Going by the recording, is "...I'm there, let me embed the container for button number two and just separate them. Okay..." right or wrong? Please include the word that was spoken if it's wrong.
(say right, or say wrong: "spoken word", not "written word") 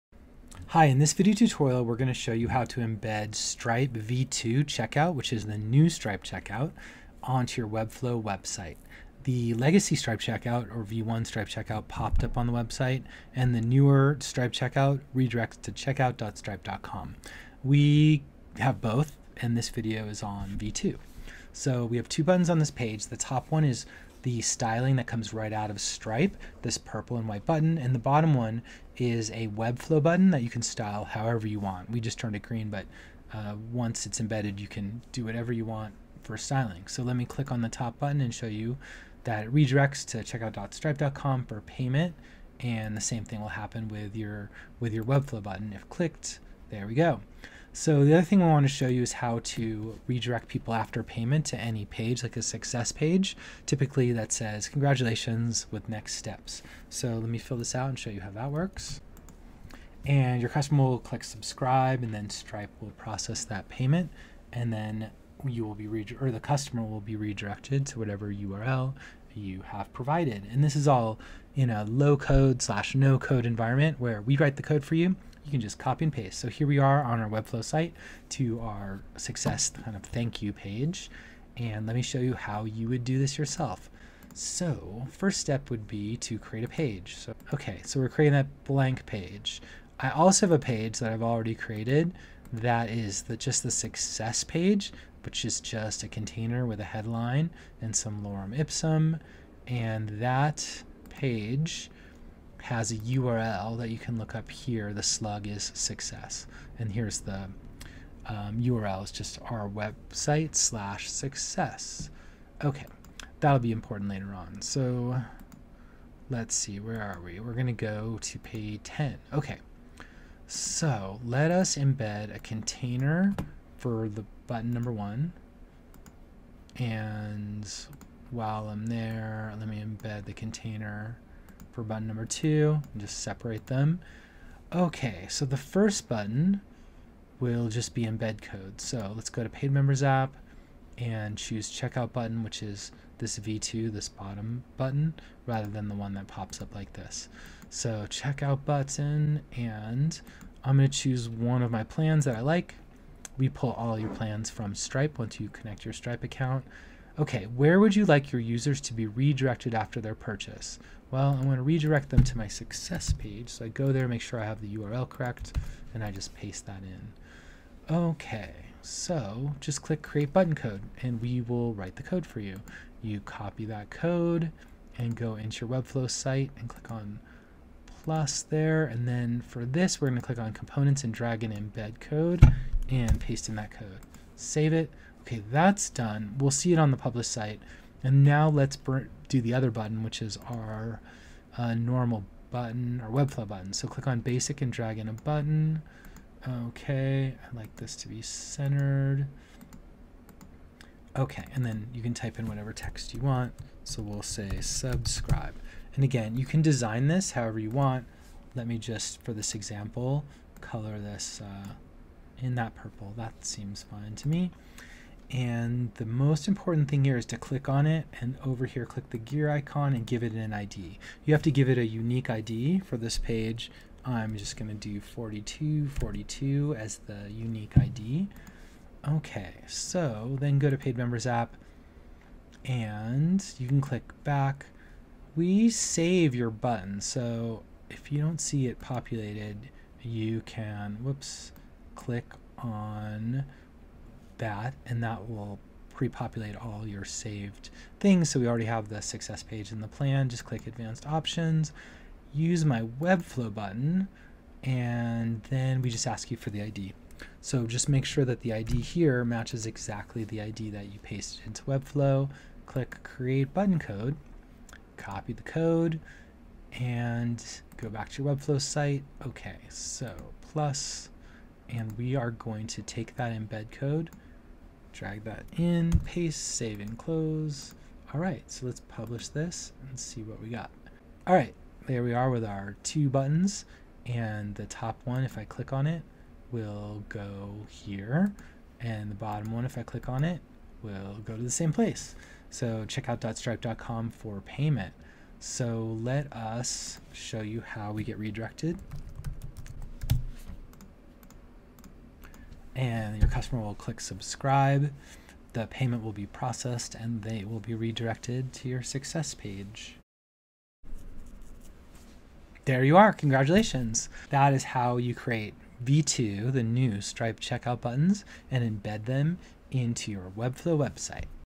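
right.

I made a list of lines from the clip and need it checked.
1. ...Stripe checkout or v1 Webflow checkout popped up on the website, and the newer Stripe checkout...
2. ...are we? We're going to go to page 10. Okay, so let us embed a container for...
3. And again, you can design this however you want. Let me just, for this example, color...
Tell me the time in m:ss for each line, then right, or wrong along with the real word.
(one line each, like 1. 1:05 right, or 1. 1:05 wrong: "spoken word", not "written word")
1. 0:09 wrong: "Stripe", not "Webflow"
2. 1:57 right
3. 3:25 right.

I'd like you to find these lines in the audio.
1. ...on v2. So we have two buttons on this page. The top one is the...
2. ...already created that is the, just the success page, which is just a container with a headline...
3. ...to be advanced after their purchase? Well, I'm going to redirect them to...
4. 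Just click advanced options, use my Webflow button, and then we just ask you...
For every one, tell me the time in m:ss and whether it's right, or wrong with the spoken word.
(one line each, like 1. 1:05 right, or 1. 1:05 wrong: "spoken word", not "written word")
1. 0:20 right
2. 1:31 right
3. 2:38 wrong: "redirected", not "advanced"
4. 4:10 right.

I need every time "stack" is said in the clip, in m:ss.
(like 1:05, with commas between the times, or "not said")
not said.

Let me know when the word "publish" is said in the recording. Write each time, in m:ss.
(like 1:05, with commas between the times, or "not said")
3:06, 4:38.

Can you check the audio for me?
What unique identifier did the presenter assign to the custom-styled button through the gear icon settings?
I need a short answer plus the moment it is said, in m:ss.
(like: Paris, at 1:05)
4242, at 3:44.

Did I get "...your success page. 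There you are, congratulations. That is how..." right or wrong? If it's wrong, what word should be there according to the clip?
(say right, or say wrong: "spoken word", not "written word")
right.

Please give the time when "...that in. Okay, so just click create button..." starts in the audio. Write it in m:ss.
2:46.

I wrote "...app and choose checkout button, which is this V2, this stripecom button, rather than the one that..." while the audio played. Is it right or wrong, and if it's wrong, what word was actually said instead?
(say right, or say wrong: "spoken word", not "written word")
wrong: "bottom", not "stripecom".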